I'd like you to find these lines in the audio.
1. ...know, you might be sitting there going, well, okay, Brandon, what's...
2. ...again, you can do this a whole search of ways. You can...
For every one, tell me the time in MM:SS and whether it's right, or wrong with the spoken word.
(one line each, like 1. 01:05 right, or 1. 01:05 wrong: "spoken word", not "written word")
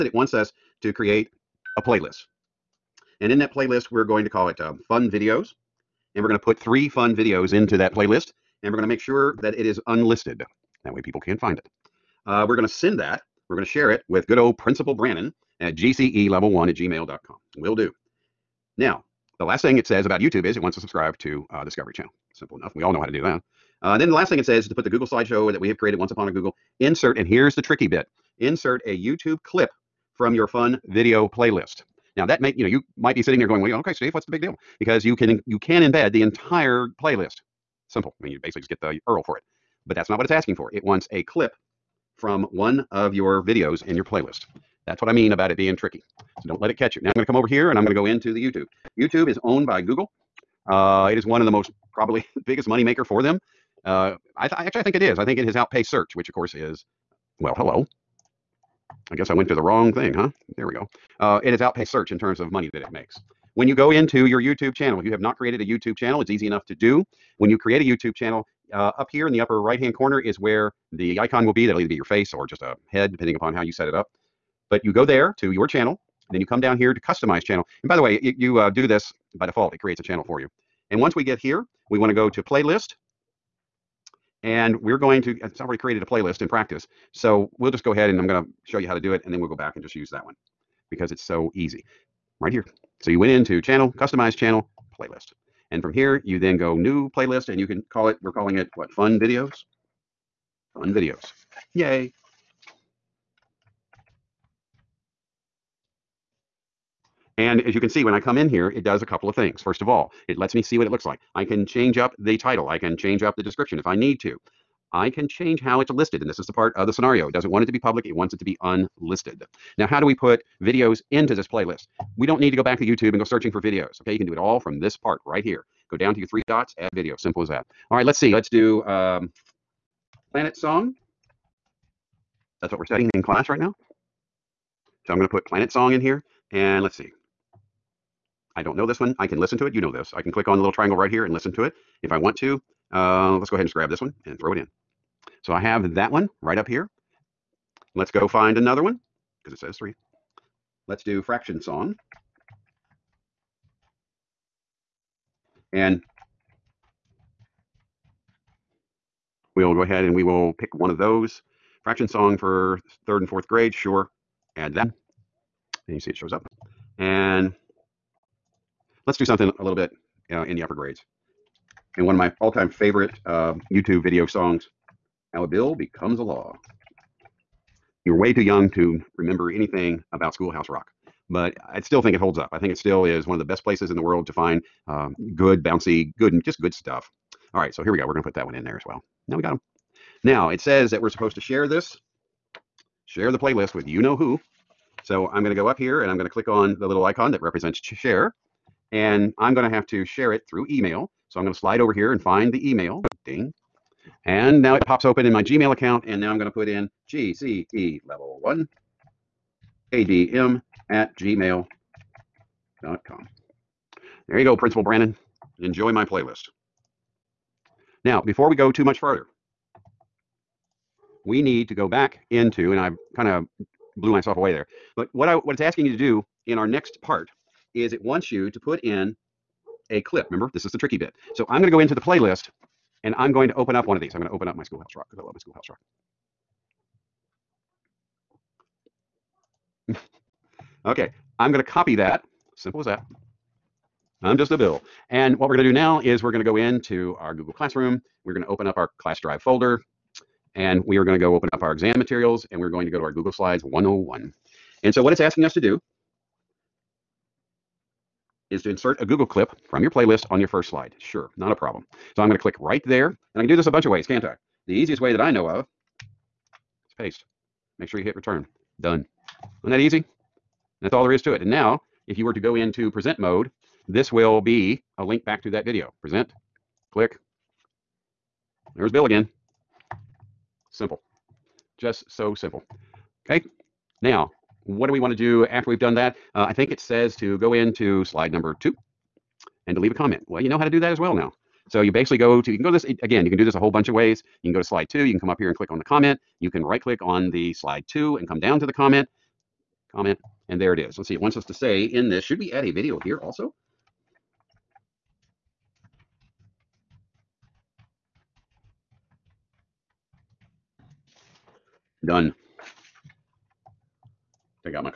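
1. 00:32 wrong: "Steve", not "Brandon"
2. 04:53 wrong: "bunch", not "search".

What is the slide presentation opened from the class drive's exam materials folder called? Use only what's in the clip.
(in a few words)
Google Slides 101.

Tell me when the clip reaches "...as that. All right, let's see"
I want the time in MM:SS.
02:07.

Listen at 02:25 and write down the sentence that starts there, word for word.
So I have that one right up here.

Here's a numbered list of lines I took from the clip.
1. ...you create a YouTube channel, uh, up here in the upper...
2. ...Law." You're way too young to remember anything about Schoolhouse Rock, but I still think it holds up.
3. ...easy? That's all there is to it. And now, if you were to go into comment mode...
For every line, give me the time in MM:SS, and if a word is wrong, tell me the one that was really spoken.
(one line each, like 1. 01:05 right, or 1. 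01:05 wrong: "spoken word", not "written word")
1. 01:07 right
2. 02:56 right
3. 04:29 wrong: "present", not "comment".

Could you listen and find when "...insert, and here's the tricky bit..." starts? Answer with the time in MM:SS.
00:26.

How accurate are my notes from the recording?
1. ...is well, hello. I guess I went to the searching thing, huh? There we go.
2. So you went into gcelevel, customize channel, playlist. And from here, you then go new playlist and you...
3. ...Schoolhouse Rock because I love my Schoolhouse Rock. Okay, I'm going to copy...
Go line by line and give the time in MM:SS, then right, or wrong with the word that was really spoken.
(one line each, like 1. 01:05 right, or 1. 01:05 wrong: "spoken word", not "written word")
1. 00:56 wrong: "wrong", not "searching"
2. 01:33 wrong: "channel", not "gcelevel"
3. 03:54 right.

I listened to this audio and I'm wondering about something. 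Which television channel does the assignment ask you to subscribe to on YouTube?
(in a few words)
Discovery Channel.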